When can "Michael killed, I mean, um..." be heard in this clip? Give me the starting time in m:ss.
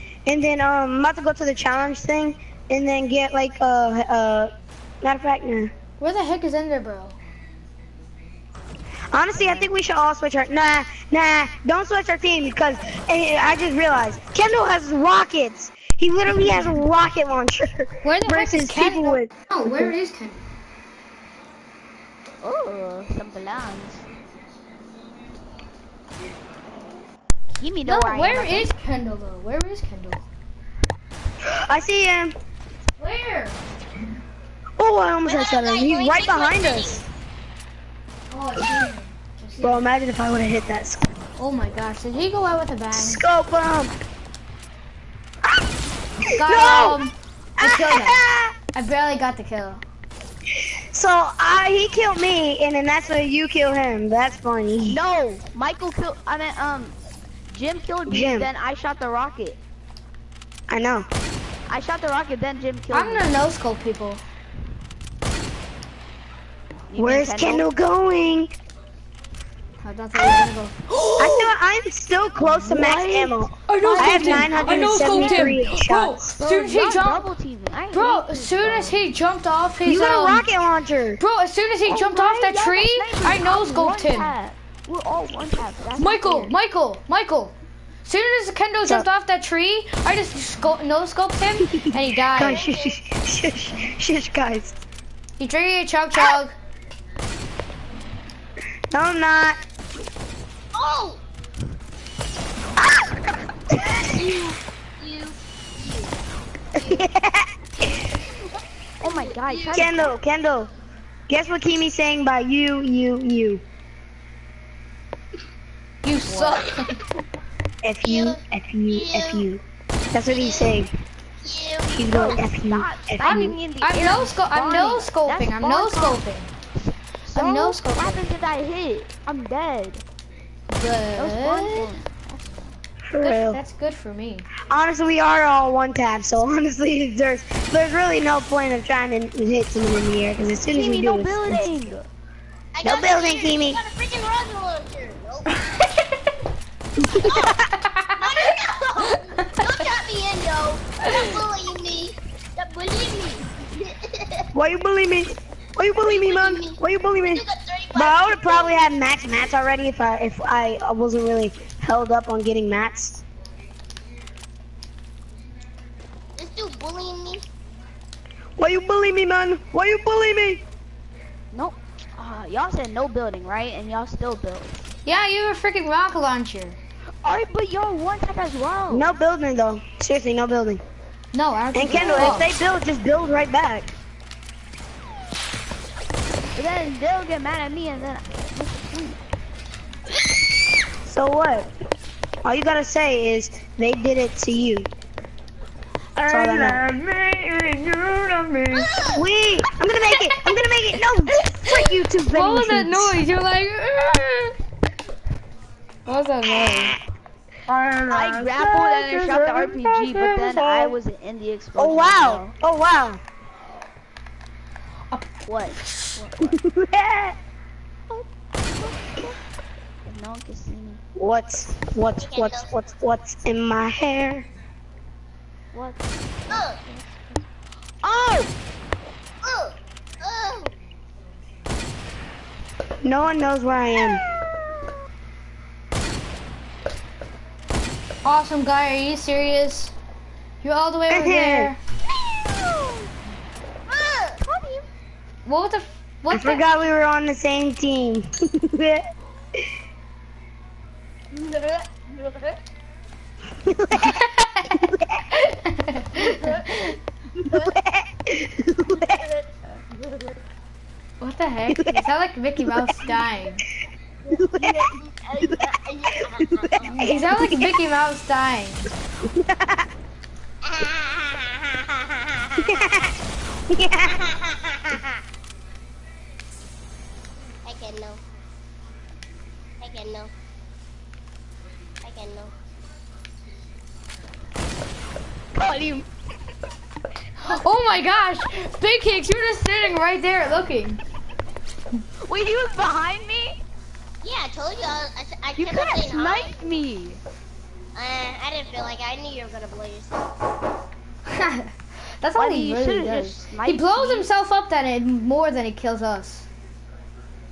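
0:55.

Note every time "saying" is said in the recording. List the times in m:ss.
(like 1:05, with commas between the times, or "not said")
1:51, 2:00.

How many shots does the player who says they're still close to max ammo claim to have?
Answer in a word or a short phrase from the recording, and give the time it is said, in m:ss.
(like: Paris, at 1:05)
973, at 1:14.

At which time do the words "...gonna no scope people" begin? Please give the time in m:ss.
1:03.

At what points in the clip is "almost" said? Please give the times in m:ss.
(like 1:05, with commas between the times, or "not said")
0:35.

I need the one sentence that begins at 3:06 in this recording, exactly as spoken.
But then they'll get mad at me and then...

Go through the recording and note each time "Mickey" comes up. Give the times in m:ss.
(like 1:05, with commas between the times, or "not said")
4:22, 4:27.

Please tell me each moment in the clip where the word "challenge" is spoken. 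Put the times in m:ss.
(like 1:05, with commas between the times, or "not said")
0:01.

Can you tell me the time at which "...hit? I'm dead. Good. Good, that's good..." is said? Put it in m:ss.
2:08.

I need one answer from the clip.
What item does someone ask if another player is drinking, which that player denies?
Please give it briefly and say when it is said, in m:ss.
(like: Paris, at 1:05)
chug jug, at 1:35.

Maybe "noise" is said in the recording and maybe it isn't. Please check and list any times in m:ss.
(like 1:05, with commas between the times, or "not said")
3:22, 3:27.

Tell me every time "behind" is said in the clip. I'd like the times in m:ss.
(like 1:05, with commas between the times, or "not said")
0:36, 4:52.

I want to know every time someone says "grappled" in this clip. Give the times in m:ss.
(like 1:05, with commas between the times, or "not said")
3:28.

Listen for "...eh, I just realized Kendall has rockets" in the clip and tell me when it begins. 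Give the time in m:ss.
0:13.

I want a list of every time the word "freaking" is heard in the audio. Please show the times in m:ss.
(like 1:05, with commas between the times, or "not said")
2:23, 2:55.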